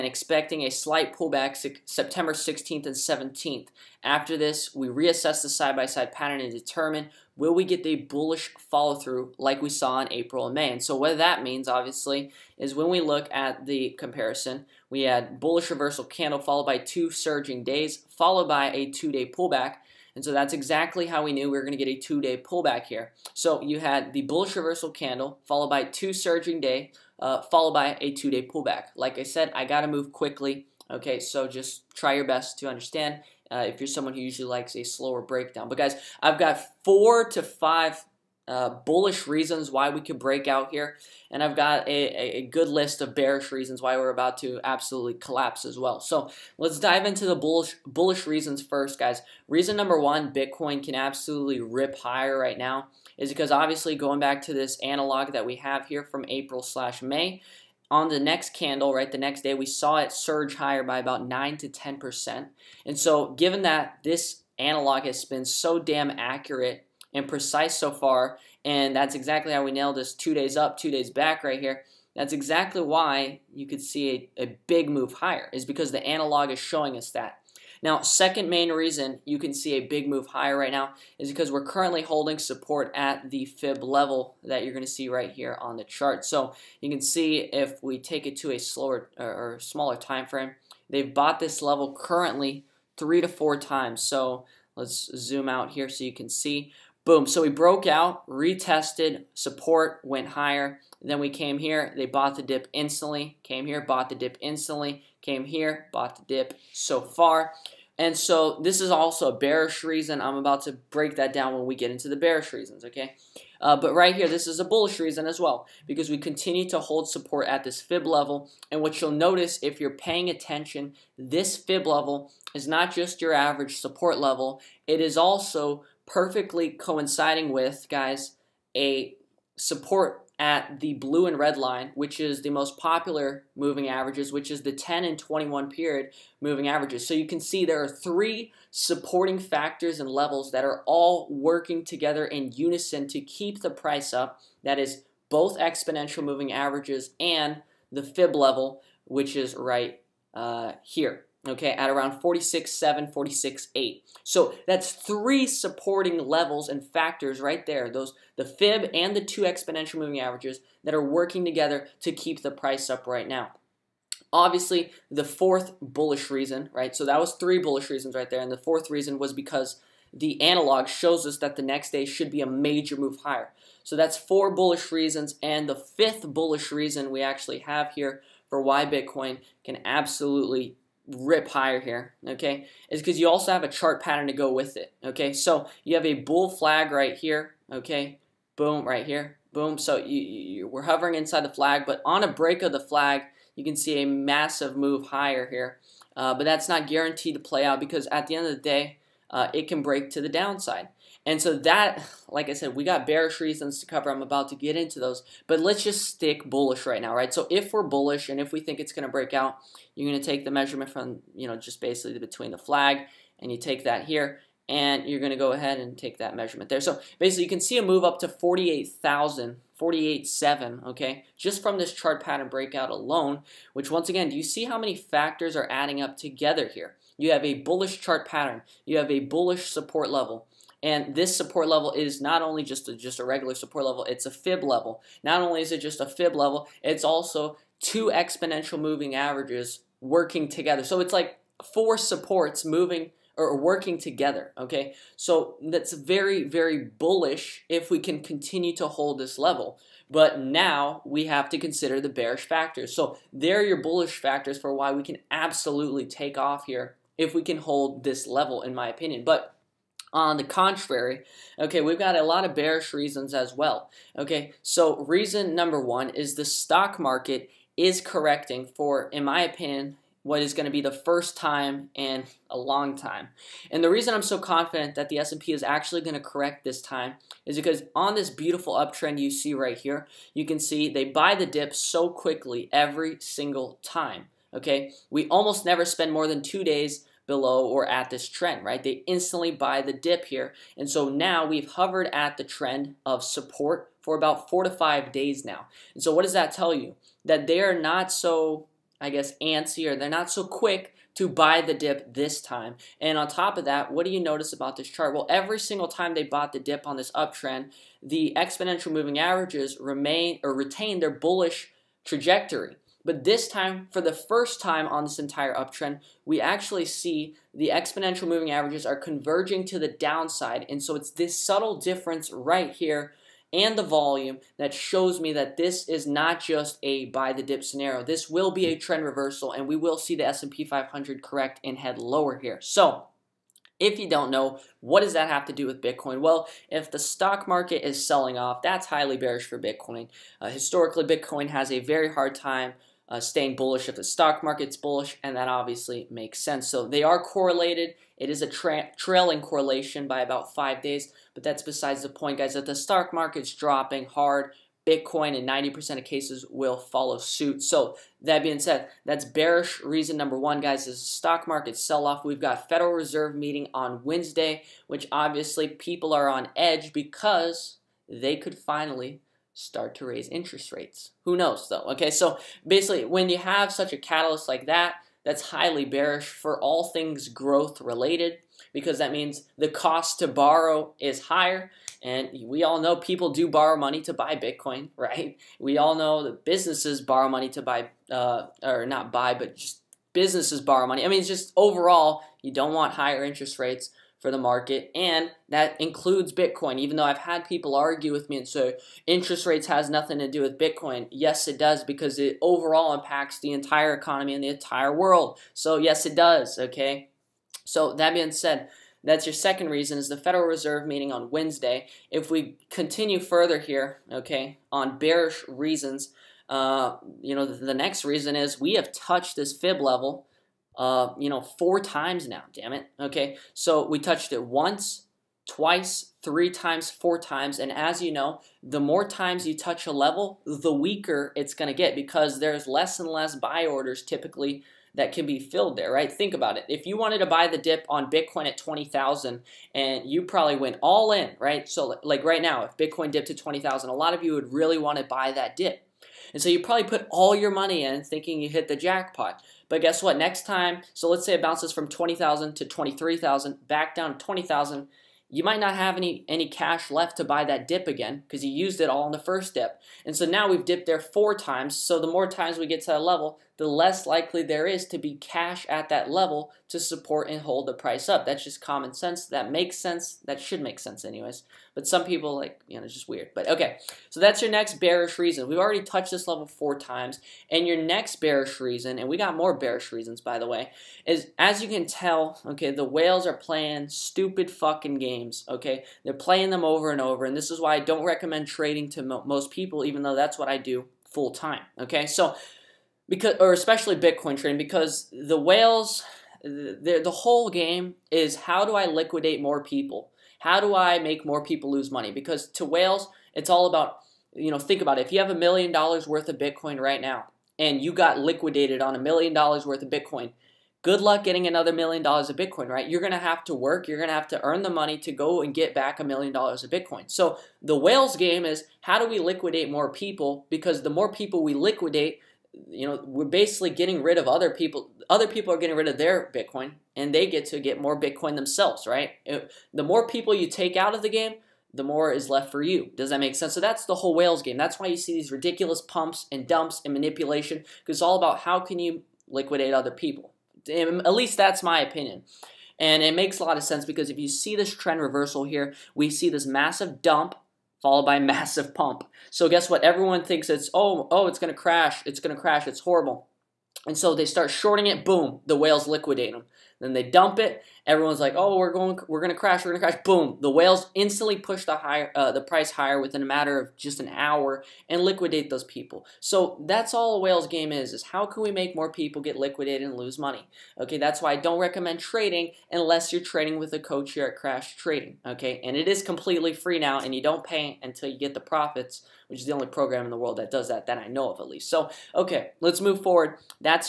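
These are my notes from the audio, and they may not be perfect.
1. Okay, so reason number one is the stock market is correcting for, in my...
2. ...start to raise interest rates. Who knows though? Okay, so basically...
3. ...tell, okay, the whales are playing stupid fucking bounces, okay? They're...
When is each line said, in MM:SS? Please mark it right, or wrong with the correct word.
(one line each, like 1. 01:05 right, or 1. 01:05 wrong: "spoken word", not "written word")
1. 04:24 right
2. 06:09 right
3. 08:01 wrong: "games", not "bounces".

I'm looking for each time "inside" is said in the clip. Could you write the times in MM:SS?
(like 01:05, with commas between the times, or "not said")
03:11.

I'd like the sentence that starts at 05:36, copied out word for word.
Well, if the stock market is selling off, that's highly bearish for Bitcoin.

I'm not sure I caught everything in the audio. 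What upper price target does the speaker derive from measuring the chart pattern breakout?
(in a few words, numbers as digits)
48.7.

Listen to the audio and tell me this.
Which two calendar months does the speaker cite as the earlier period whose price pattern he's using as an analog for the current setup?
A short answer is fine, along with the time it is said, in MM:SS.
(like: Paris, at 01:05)
April and May, at 00:10.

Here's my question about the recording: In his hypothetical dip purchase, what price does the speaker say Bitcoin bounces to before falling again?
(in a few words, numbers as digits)
23,000.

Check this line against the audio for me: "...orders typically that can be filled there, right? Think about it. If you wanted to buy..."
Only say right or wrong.
right.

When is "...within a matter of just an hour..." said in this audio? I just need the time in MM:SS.
09:23.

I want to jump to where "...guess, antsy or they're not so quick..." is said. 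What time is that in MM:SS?
04:59.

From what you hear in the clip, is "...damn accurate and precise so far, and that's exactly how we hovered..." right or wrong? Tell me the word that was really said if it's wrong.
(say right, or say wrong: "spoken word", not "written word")
wrong: "nailed", not "hovered".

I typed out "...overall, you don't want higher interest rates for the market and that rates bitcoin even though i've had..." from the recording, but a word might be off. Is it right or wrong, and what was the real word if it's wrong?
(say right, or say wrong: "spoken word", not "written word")
wrong: "includes", not "rates".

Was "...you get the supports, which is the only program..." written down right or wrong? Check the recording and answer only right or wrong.
wrong.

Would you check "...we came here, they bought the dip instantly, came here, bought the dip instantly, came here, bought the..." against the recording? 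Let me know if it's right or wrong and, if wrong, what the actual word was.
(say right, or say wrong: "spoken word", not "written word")
right.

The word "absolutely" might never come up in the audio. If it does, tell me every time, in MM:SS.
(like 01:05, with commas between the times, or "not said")
00:44, 00:50, 02:59, 04:15.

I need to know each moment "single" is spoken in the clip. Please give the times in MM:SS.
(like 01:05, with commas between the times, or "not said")
04:43, 05:05.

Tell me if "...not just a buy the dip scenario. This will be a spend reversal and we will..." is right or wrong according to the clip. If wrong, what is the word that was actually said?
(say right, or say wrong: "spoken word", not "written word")
wrong: "trend", not "spend".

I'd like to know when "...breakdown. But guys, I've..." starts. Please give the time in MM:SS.
00:35.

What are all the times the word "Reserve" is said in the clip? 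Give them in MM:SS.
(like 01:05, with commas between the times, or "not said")
06:02, 06:50.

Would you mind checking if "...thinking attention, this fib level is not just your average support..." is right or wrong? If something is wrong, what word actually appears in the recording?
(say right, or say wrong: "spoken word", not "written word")
wrong: "paying", not "thinking".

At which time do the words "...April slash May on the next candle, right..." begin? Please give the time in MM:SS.
00:56.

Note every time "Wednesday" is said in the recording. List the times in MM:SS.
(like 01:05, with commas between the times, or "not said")
06:04, 06:51.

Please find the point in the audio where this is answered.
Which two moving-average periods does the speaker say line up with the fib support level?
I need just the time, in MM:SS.
02:14.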